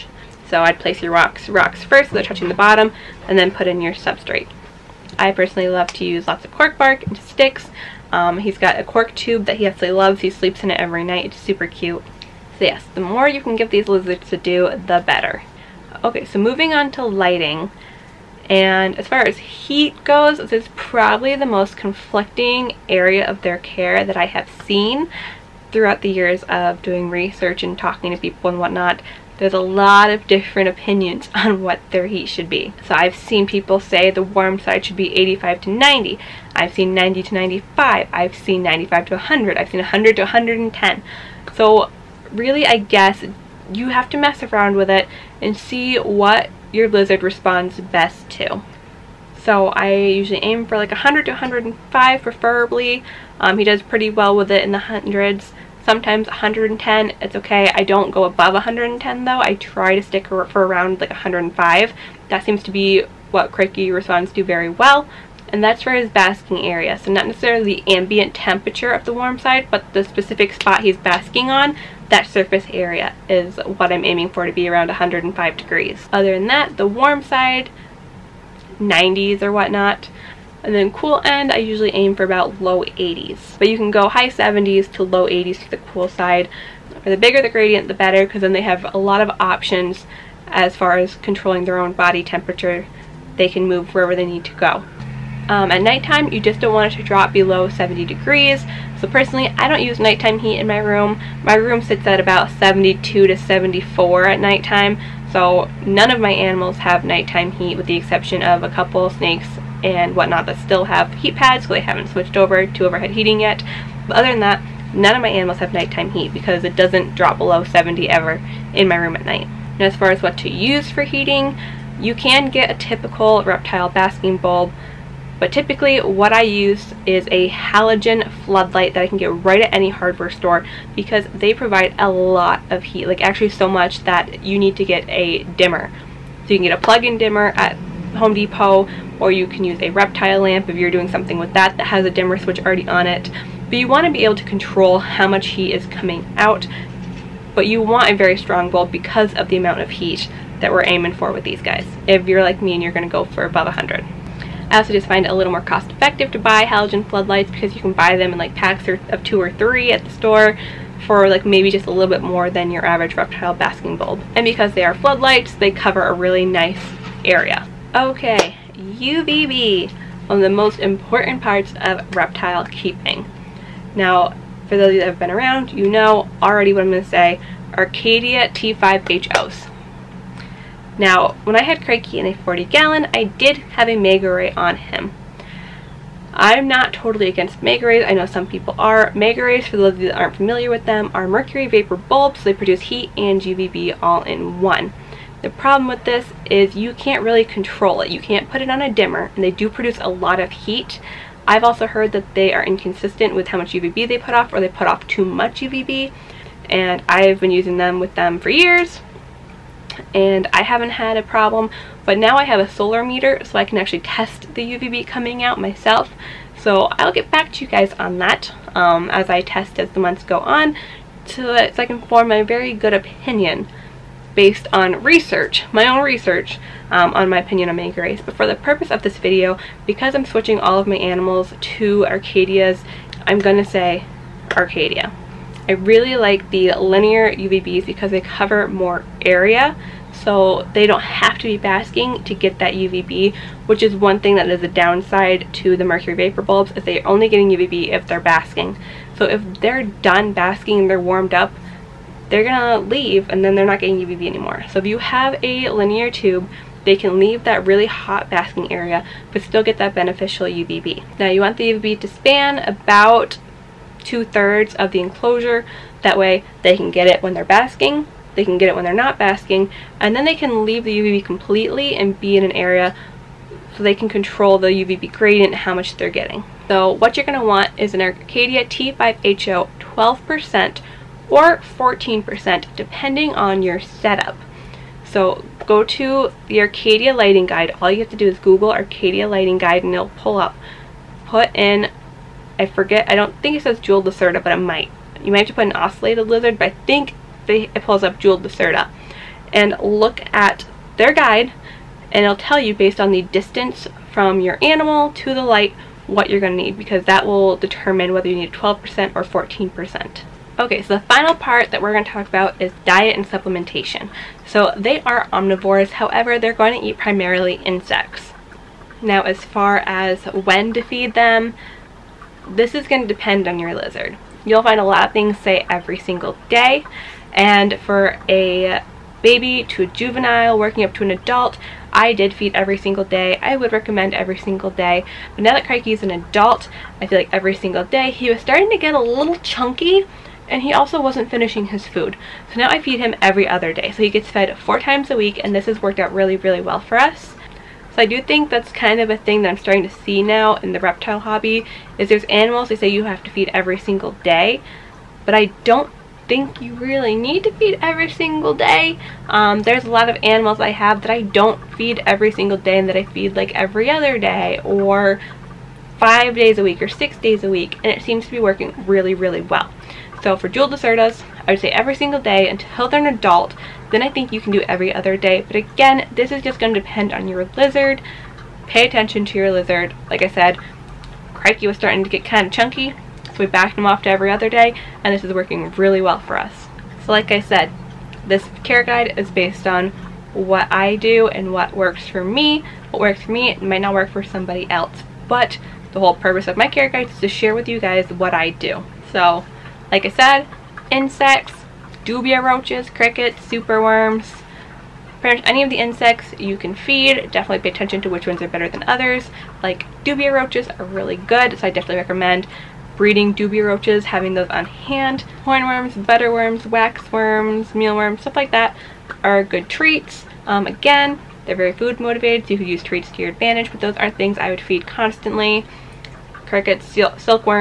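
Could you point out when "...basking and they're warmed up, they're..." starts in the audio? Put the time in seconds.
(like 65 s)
250 s.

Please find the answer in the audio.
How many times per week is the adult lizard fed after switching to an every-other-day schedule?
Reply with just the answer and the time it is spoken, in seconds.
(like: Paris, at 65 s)
4, at 344 s.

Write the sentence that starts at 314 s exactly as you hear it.
So they are omnivores, however, they're going to eat primarily insects.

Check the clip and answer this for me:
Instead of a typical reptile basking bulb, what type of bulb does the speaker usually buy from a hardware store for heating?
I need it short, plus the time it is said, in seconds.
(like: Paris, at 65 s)
Halogen floodlight, at 127 s.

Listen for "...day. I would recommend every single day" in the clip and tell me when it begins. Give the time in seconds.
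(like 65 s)
333 s.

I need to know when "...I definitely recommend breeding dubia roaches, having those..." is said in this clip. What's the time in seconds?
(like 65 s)
411 s.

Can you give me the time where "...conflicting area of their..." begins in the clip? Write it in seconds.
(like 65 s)
21 s.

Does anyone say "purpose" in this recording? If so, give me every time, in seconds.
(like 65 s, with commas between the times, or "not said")
228 s, 396 s.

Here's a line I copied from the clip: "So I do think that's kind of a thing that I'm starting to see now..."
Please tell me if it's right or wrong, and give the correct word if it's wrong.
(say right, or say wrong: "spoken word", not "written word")
right.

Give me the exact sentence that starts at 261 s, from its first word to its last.
Now you want the UVB to span about two-thirds of the enclosure.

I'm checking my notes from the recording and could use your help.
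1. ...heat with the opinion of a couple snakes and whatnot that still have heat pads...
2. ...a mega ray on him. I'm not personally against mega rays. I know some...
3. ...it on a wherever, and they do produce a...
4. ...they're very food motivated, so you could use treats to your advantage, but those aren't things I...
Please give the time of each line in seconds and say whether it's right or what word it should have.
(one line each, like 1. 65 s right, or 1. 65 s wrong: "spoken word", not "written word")
1. 107 s wrong: "exception", not "opinion"
2. 183 s wrong: "totally", not "personally"
3. 198 s wrong: "dimmer", not "wherever"
4. 421 s right.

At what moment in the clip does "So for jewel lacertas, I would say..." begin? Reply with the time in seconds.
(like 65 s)
370 s.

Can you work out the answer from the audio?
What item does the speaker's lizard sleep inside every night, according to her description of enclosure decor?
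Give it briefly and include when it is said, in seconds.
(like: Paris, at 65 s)
Cork tube, at 8 s.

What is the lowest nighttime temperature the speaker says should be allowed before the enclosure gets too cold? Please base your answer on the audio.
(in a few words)
70 degrees.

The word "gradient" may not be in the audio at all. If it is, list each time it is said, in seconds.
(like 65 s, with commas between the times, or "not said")
87 s, 275 s.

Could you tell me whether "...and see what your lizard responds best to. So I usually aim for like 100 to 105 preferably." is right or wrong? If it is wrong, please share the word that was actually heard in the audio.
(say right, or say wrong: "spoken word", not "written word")
right.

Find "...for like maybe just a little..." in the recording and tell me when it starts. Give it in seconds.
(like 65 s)
161 s.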